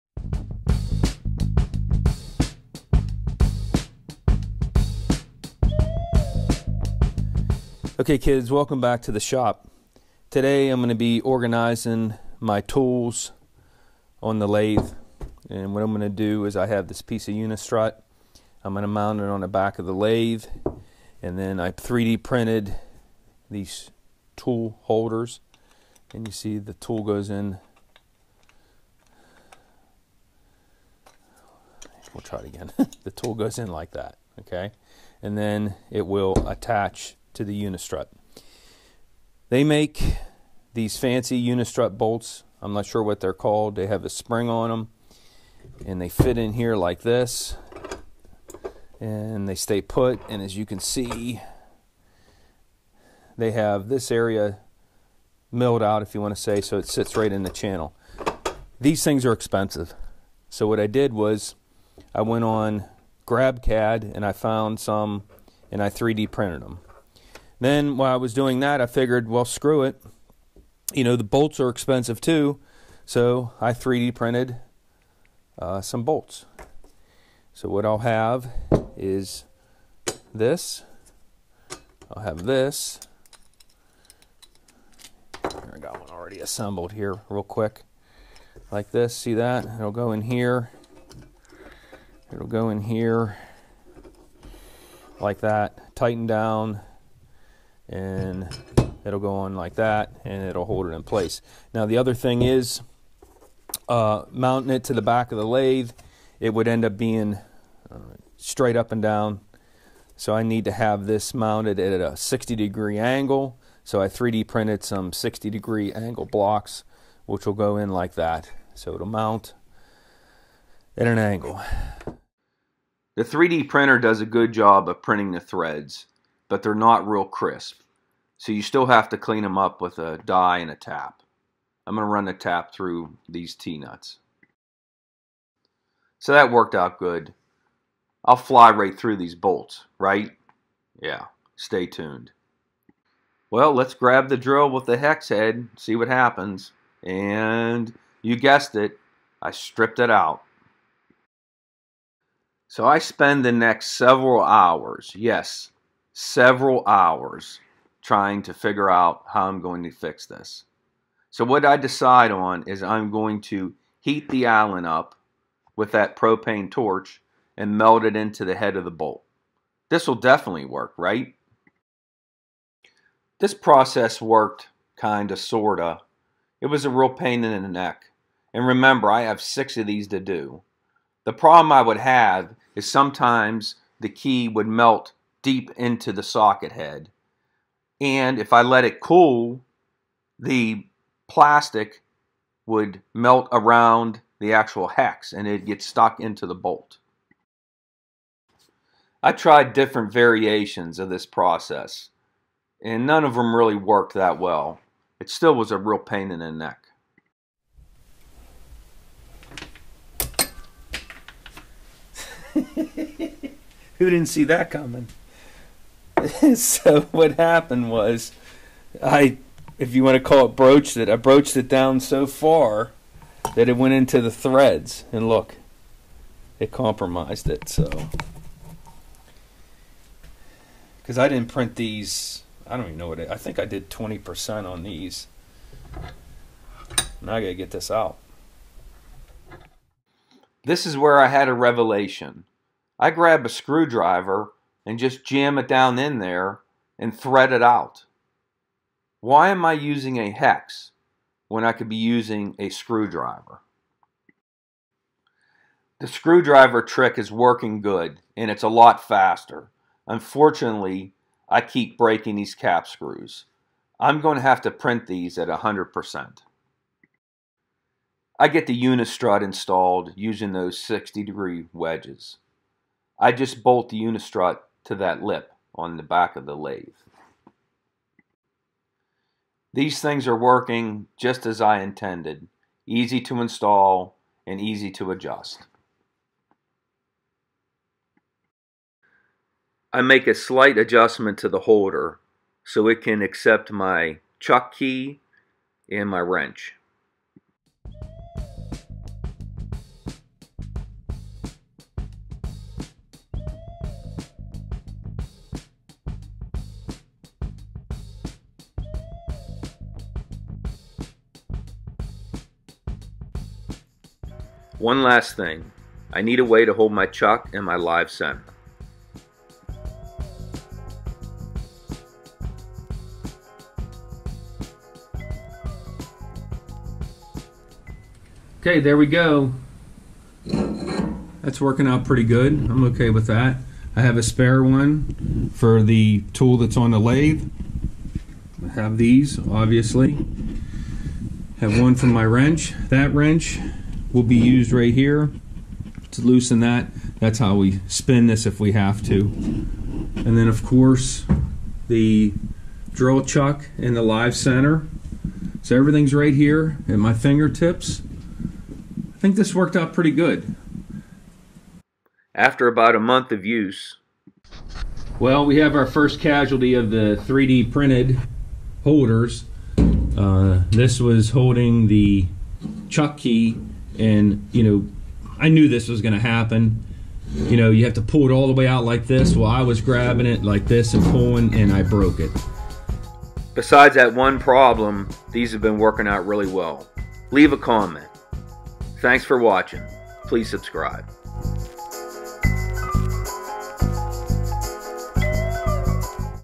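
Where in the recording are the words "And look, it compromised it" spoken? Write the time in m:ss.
3:45.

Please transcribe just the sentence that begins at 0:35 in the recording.
And then it will attach to the Unistrut.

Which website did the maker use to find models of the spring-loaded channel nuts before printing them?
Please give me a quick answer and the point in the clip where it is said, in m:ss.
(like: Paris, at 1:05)
GrabCAD, at 1:03.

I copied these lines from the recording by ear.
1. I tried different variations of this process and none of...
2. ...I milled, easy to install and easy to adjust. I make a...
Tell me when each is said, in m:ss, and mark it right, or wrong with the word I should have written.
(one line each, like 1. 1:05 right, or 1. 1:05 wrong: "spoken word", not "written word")
1. 3:19 right
2. 4:41 wrong: "intended", not "milled".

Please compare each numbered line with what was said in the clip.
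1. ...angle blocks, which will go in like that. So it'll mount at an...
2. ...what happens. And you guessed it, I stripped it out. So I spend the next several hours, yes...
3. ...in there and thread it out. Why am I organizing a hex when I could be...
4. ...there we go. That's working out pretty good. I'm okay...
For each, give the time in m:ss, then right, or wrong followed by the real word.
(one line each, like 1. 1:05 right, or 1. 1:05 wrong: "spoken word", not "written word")
1. 1:55 right
2. 2:25 right
3. 4:05 wrong: "using", not "organizing"
4. 5:28 right.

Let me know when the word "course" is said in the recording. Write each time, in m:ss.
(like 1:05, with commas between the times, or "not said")
5:50.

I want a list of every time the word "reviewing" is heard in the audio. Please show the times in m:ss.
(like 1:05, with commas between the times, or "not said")
not said.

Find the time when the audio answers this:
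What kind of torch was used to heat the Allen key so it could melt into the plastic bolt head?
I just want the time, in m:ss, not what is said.
2:46.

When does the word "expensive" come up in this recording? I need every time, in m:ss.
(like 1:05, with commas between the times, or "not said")
0:59, 1:11.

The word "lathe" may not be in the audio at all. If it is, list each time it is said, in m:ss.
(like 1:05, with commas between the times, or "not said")
0:14, 0:19, 1:45, 4:36, 5:36.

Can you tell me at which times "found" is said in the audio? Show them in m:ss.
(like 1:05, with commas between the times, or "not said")
1:04.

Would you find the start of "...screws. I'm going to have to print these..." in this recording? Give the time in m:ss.
4:22.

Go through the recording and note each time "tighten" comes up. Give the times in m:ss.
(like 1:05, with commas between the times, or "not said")
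1:35.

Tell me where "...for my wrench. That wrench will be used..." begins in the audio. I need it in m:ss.
5:41.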